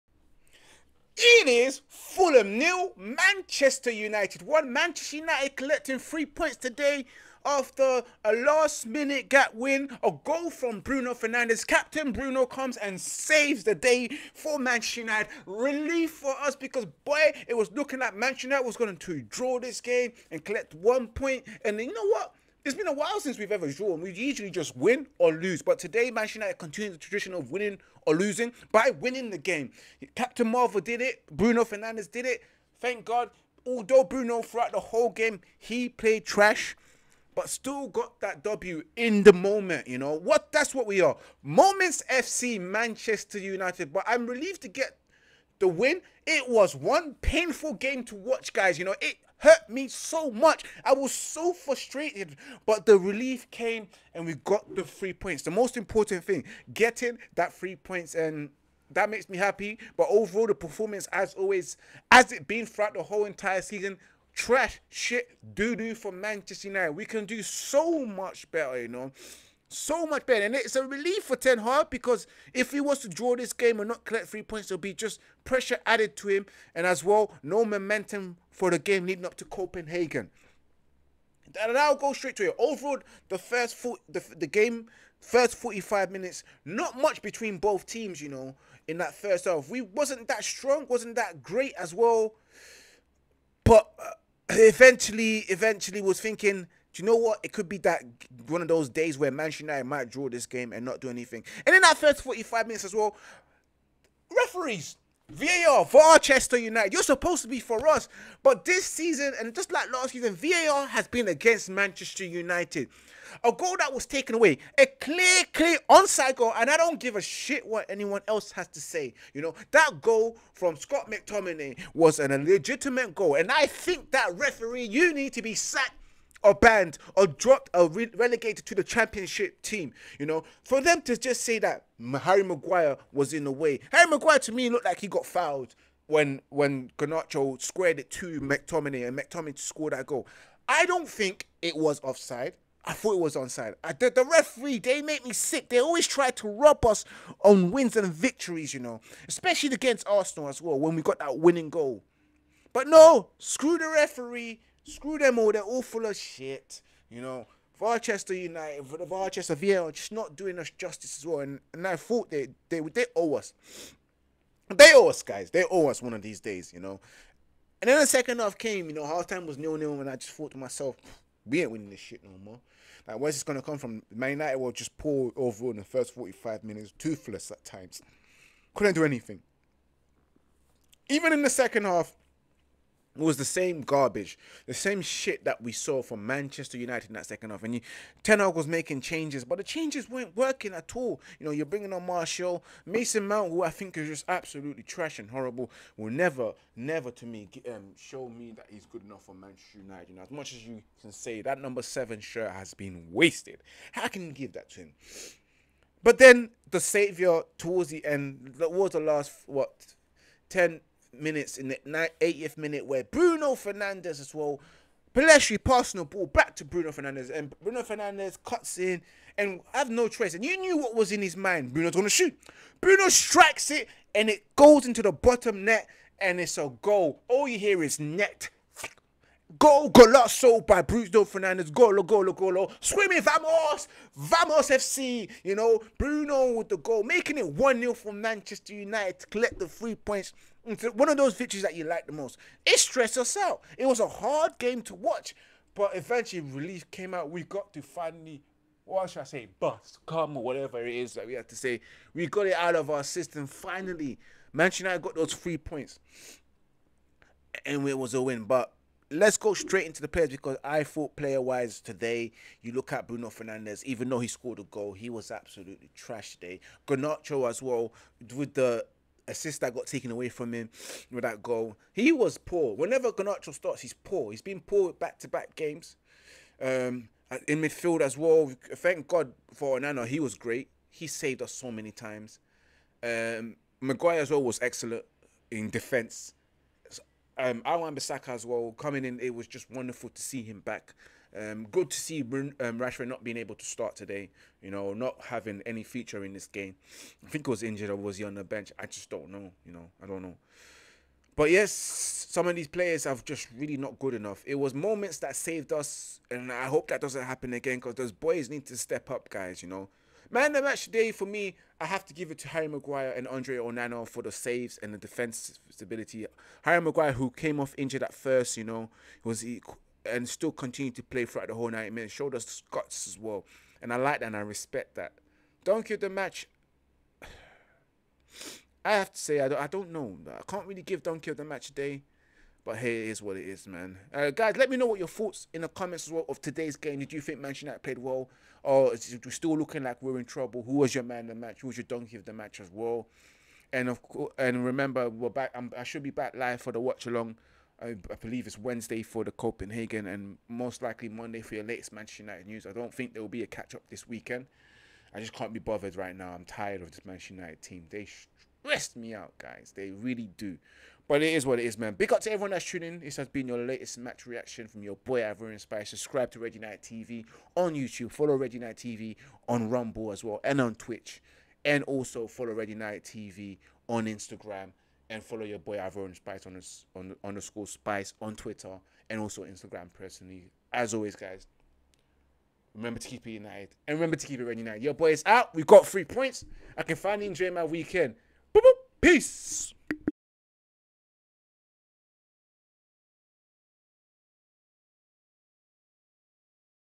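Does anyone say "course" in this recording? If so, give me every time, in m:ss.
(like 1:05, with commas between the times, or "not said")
5:44.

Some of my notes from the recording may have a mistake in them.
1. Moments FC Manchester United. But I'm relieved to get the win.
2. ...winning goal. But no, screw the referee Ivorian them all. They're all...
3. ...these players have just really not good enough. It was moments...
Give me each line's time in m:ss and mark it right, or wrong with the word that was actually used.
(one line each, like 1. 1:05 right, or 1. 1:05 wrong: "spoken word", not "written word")
1. 0:41 right
2. 2:31 wrong: "Screw", not "Ivorian"
3. 5:02 right.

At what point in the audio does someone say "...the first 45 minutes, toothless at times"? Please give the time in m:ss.
2:55.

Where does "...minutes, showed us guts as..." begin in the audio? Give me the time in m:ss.
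5:21.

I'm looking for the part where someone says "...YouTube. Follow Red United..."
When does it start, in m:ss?
6:07.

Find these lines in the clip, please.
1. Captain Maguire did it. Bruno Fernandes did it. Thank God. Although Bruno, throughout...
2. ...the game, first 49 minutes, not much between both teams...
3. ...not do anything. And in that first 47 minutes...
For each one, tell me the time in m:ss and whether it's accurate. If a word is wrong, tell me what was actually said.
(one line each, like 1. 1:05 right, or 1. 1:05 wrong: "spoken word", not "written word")
1. 0:30 wrong: "Marvel", not "Maguire"
2. 1:24 wrong: "45", not "49"
3. 1:40 wrong: "45", not "47".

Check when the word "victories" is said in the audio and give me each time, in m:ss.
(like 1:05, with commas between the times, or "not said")
2:28, 4:01.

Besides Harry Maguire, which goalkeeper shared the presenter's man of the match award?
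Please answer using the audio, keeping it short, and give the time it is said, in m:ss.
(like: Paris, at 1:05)
Andre Onana, at 5:13.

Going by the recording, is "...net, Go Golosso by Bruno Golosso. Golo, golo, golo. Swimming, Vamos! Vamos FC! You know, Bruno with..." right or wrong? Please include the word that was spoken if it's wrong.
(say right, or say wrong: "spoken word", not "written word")
wrong: "Fernandes", not "Golosso".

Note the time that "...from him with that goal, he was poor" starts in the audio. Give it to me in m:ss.
4:30.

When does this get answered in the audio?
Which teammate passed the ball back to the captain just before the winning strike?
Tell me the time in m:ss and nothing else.
3:35.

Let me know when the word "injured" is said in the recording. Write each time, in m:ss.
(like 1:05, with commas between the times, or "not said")
4:57, 5:17.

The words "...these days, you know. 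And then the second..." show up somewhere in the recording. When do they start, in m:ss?
2:46.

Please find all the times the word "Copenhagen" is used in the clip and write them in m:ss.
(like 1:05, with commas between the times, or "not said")
1:19, 5:49.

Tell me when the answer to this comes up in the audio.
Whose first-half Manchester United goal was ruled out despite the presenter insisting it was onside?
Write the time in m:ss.
2:00.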